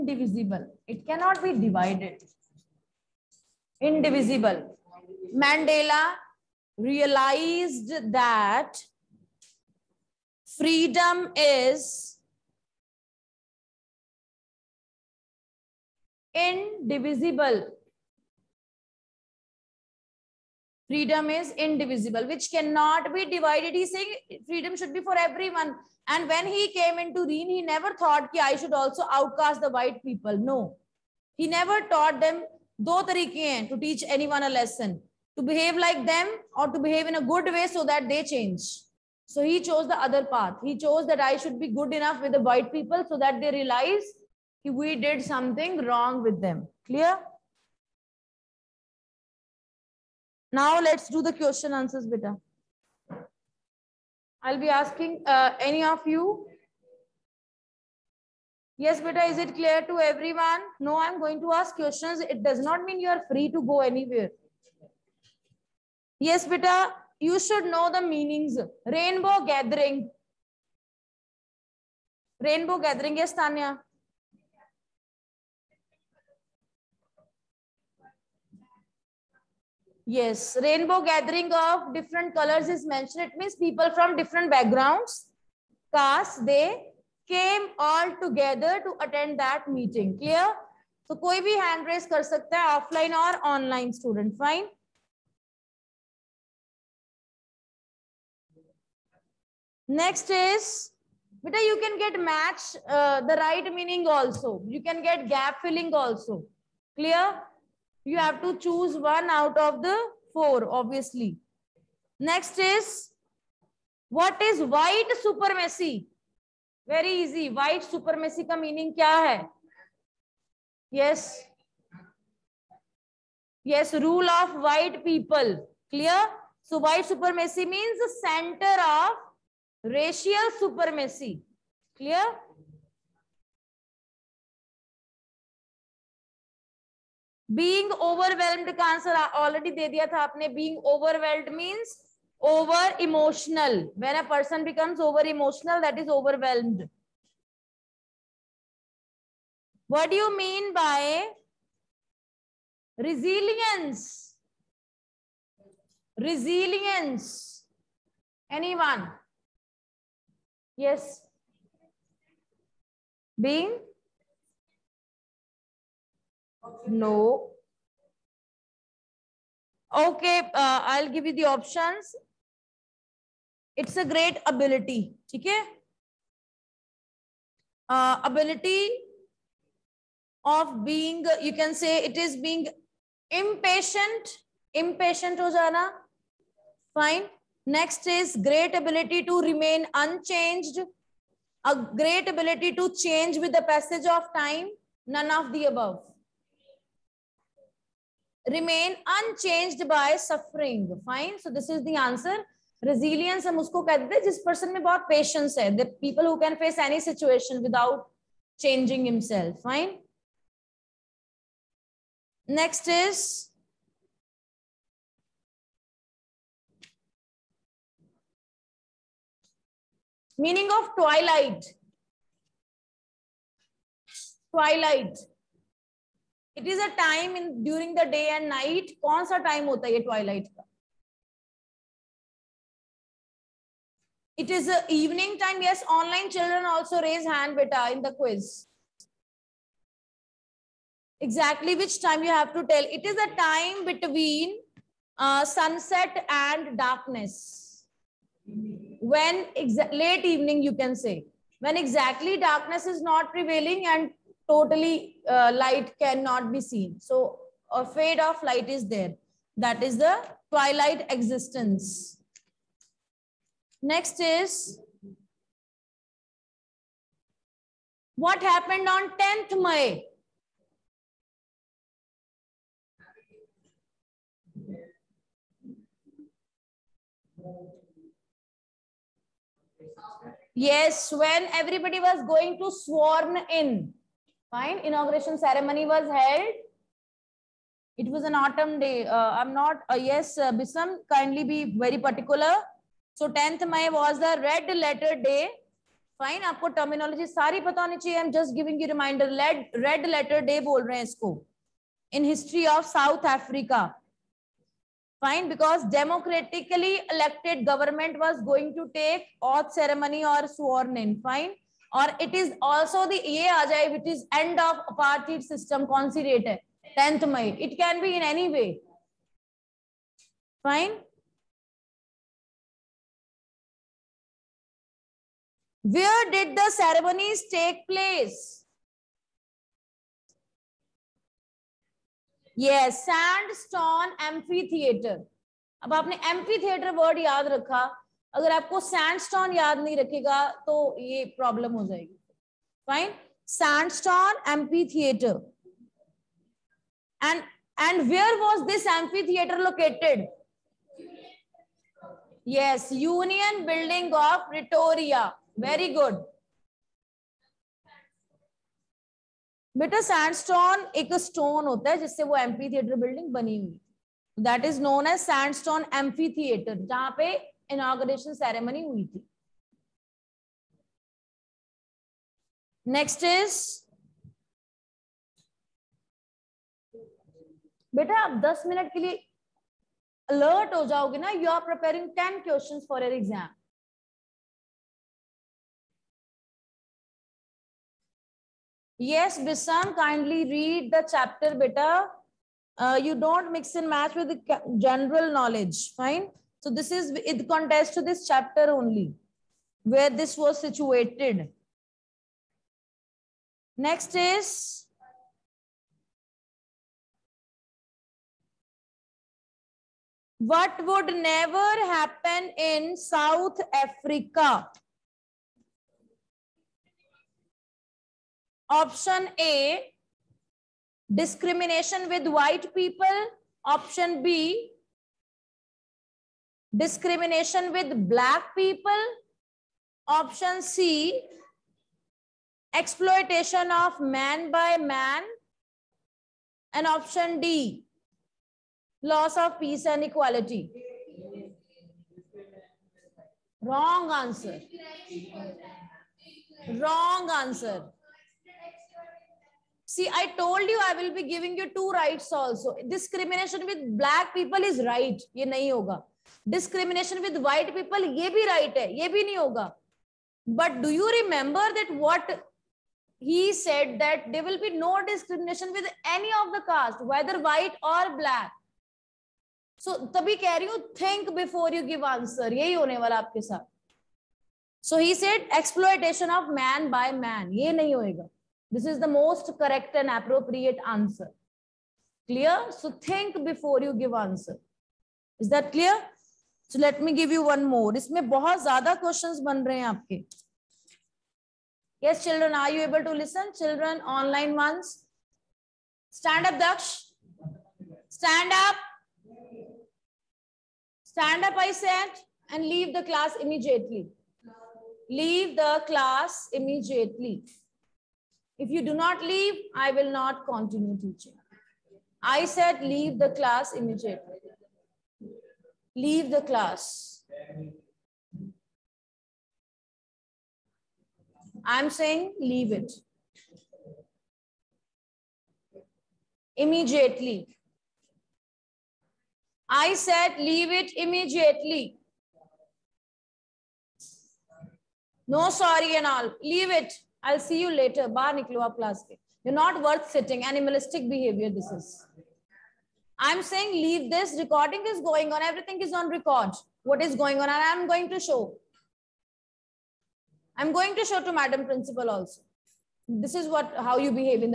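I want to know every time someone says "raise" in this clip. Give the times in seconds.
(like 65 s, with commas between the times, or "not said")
91 s, 237 s.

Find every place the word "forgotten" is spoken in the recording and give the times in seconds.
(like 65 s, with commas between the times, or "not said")
not said.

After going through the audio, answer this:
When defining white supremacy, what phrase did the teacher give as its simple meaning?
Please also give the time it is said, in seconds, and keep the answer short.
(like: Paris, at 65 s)
Rule of white people, at 124 s.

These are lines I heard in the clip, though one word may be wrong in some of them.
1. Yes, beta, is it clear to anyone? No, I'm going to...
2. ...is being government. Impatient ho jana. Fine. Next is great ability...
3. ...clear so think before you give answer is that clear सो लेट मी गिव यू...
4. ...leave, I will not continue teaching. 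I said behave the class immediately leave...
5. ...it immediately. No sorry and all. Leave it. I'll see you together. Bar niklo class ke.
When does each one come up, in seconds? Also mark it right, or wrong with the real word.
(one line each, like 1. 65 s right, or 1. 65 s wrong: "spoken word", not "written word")
1. 58 s wrong: "everyone", not "anyone"
2. 182 s wrong: "impatient", not "government"
3. 482 s right
4. 509 s wrong: "leave", not "behave"
5. 530 s wrong: "later", not "together".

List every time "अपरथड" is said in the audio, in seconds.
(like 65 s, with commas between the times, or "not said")
314 s.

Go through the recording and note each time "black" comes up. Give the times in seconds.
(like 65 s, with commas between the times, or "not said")
428 s, 453 s, 468 s.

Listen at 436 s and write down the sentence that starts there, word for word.
And option D, loss of peace and equality.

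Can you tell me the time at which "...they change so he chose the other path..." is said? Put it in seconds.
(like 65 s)
38 s.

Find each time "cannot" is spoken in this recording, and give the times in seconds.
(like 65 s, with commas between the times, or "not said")
1 s, 22 s, 255 s.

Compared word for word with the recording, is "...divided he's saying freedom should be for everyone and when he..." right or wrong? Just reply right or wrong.
right.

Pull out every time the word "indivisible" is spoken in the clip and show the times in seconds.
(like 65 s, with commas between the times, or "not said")
3 s, 16 s, 21 s.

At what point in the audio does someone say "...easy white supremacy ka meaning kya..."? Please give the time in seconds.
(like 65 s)
117 s.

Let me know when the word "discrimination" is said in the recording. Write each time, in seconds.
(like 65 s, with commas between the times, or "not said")
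421 s, 426 s, 452 s, 465 s.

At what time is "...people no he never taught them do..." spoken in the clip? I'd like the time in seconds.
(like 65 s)
30 s.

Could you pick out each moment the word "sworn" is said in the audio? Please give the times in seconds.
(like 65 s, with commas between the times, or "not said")
282 s, 310 s.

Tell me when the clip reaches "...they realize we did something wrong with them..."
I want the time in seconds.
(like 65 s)
43 s.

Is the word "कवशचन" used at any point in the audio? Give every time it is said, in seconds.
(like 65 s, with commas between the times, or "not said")
382 s, 489 s.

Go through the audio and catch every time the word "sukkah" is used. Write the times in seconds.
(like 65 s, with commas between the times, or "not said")
not said.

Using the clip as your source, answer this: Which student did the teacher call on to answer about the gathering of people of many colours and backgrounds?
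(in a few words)
Tanya.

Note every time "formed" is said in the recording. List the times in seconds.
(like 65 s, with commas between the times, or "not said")
not said.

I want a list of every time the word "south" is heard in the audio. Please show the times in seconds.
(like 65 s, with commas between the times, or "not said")
302 s, 412 s.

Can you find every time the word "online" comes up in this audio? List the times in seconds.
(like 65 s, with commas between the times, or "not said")
93 s, 235 s.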